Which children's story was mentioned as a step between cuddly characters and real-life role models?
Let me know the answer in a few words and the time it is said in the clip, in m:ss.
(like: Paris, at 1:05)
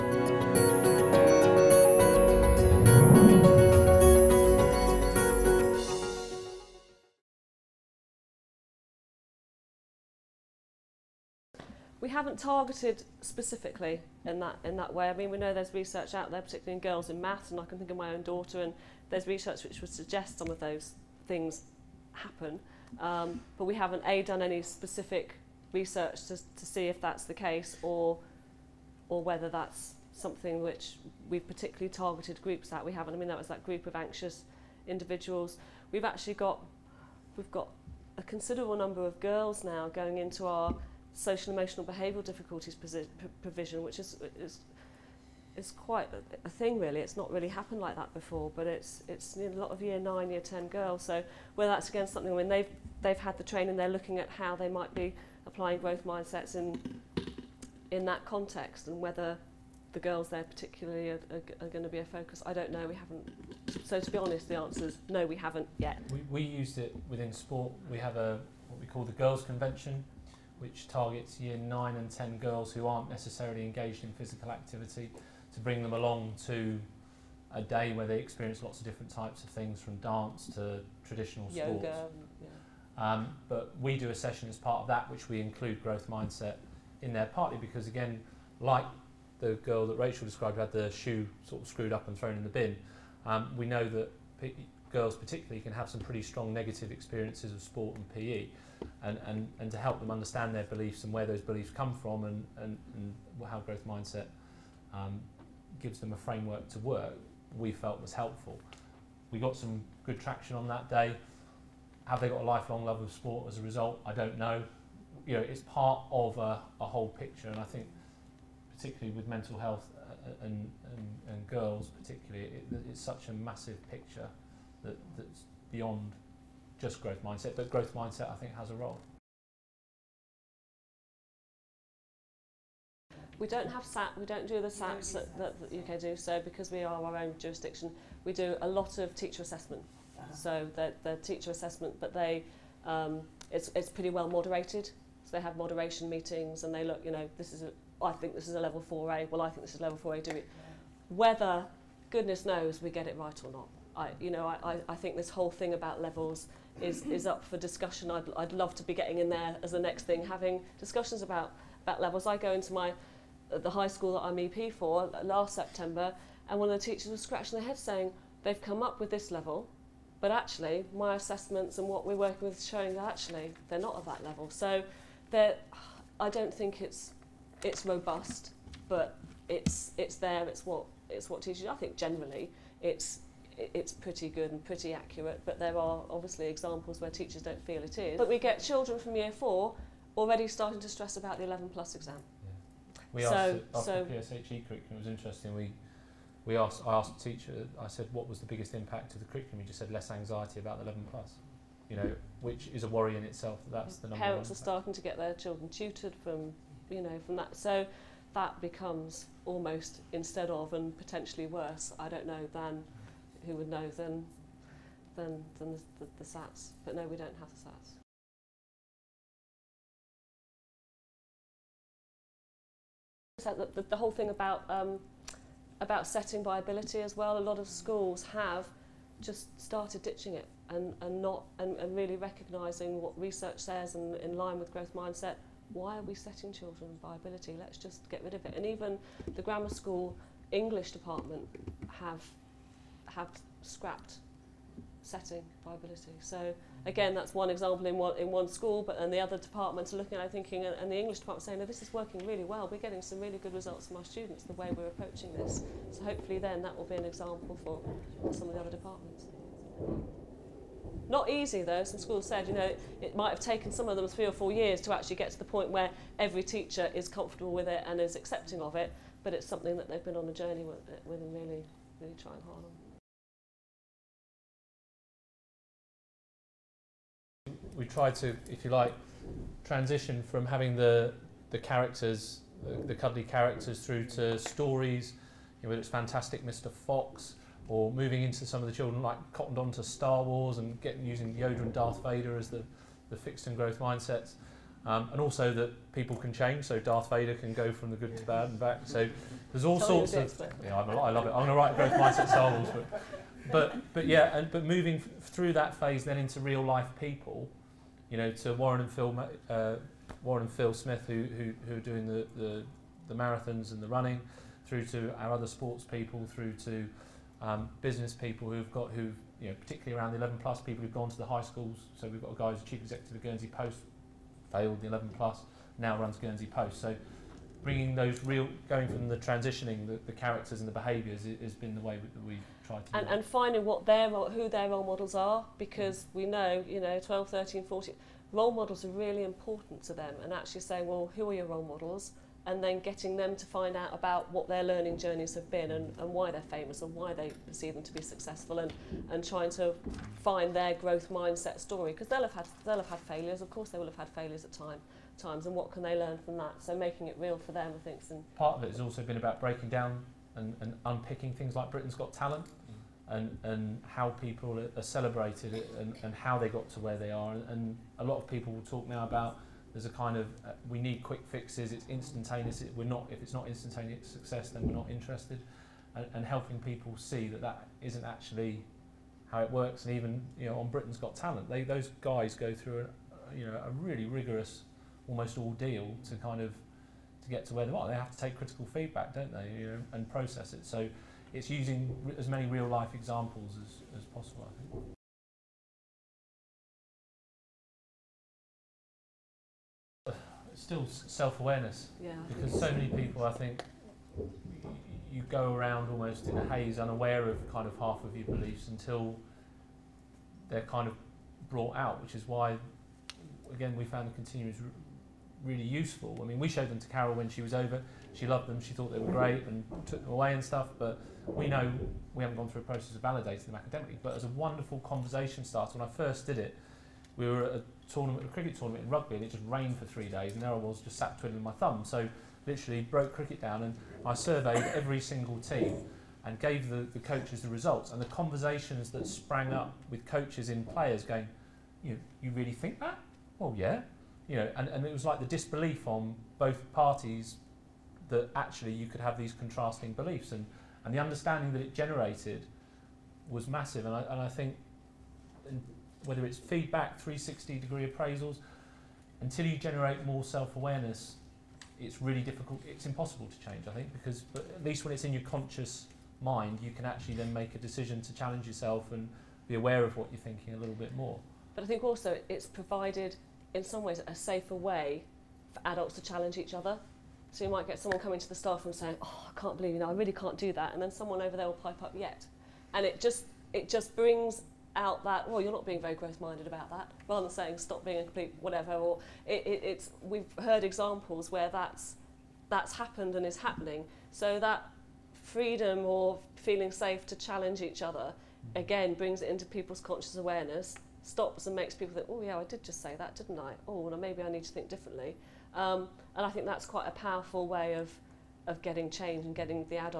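Fantastic Mr. Fox, at 4:45.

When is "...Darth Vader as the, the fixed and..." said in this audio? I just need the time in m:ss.
4:51.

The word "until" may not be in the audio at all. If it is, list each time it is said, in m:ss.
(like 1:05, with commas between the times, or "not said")
6:48, 7:39.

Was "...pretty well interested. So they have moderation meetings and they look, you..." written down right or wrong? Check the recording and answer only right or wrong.
wrong.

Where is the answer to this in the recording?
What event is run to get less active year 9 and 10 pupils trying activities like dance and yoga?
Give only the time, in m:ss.
1:09.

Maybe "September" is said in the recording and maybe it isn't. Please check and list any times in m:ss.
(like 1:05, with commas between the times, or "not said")
2:45.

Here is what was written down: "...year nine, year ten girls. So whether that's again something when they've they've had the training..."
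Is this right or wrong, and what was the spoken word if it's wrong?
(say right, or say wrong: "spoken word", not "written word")
right.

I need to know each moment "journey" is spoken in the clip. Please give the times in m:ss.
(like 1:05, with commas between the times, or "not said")
4:30, 5:44.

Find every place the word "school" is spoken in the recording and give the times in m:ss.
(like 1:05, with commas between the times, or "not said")
2:43, 3:47, 3:59, 4:08, 4:21, 5:21.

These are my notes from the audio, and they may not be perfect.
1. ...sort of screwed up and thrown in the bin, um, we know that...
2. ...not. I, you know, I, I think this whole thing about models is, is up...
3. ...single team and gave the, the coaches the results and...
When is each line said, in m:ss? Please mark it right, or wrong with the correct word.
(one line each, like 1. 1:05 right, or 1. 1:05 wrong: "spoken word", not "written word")
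1. 1:31 right
2. 2:33 wrong: "levels", not "models"
3. 7:14 right.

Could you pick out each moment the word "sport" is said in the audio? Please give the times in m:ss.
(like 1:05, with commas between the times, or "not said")
1:07, 1:21, 1:37, 1:53, 5:15.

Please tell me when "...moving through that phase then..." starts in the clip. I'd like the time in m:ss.
5:04.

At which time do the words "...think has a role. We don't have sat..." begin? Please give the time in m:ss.
2:08.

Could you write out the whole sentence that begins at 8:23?
Oh, well, maybe I need to think differently.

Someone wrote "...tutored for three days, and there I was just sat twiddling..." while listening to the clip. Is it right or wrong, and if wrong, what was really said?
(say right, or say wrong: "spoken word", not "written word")
wrong: "rained", not "tutored".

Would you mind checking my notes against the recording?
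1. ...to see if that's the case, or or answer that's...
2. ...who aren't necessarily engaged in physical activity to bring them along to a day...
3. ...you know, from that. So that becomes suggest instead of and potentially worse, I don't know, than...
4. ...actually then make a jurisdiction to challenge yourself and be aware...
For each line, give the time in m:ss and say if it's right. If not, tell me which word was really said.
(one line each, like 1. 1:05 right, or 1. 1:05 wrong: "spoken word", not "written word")
1. 0:26 wrong: "whether", not "answer"
2. 1:12 right
3. 3:26 wrong: "almost", not "suggest"
4. 7:46 wrong: "decision", not "jurisdiction".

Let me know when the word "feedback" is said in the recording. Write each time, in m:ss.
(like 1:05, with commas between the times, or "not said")
6:28, 7:36.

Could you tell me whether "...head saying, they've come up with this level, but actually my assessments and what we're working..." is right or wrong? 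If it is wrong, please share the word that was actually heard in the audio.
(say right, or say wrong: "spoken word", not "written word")
right.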